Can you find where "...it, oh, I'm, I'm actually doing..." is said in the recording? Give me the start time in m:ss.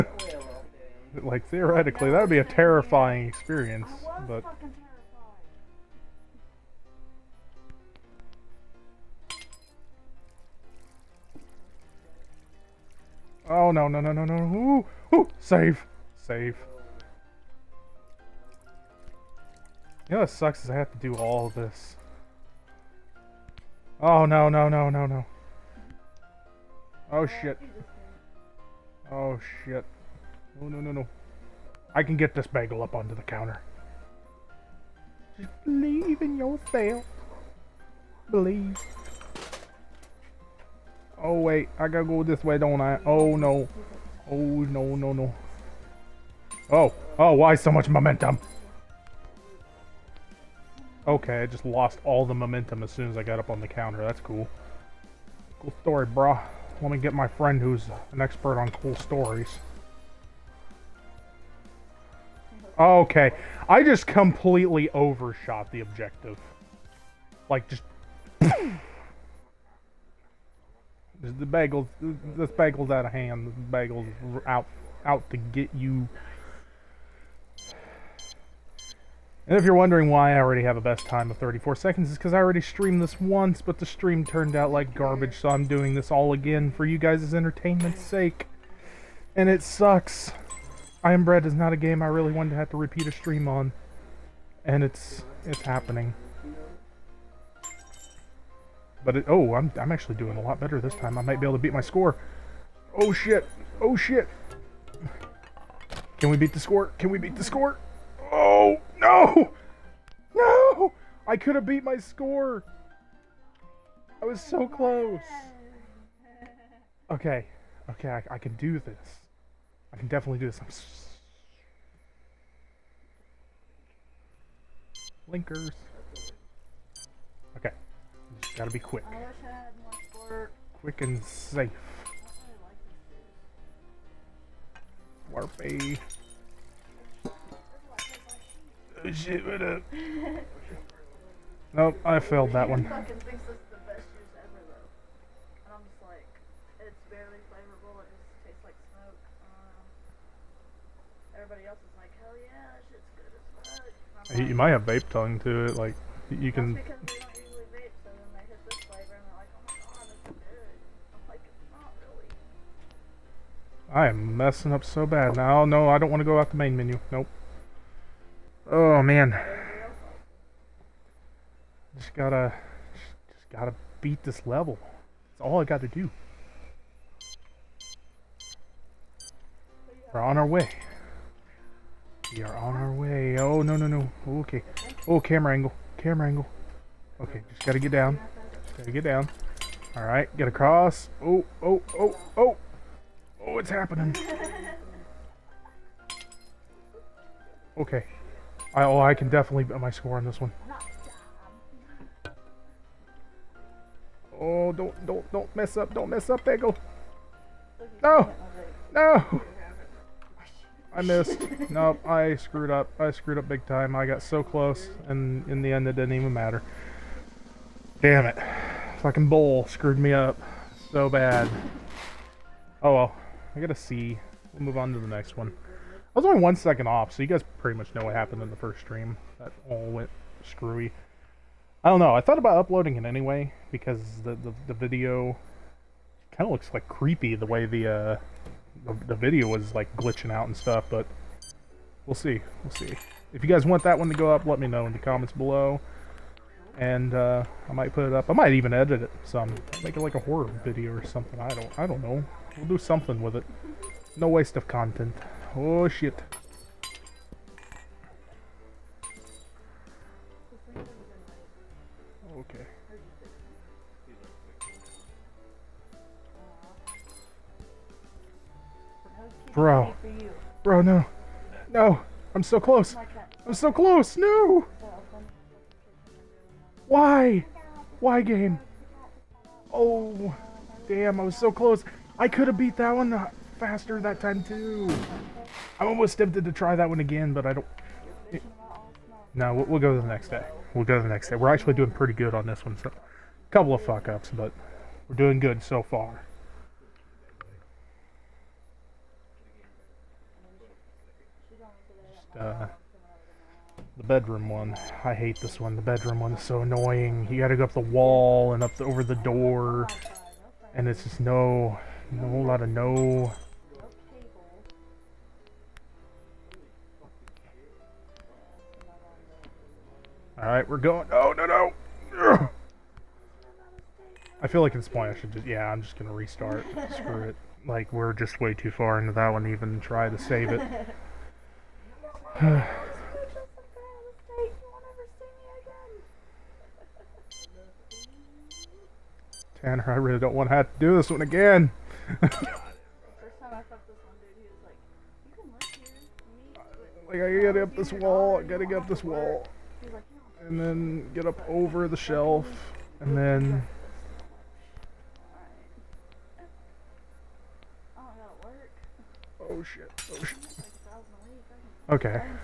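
1:39.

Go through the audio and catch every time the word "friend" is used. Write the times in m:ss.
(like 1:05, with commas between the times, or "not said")
0:57.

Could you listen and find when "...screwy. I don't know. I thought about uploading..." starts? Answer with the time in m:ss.
3:50.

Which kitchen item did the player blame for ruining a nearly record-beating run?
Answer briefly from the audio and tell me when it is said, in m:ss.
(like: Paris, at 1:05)
bowl, at 3:39.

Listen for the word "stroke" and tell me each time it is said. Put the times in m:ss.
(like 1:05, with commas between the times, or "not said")
not said.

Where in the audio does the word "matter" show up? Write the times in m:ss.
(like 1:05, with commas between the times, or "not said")
3:36.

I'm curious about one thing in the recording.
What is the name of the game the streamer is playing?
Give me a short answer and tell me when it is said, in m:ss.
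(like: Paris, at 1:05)
I Am Bread, at 1:31.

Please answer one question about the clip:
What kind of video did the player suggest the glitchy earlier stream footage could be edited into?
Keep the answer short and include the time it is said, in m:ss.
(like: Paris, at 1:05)
horror video, at 4:10.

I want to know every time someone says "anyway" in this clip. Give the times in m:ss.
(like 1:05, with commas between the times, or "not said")
3:53.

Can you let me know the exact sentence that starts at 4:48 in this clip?
It, no, we'll, we'll, go to the next day.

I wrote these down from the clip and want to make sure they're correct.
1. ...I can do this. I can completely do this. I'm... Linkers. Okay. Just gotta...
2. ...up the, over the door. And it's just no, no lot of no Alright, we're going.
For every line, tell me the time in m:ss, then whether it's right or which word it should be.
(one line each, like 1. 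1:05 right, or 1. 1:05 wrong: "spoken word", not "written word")
1. 1:58 wrong: "definitely", not "completely"
2. 5:08 right.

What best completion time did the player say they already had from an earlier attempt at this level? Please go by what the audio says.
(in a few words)
34 seconds.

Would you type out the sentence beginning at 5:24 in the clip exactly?
I feel like at this point I should just...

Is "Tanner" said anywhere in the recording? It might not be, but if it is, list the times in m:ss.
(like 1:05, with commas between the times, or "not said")
5:39.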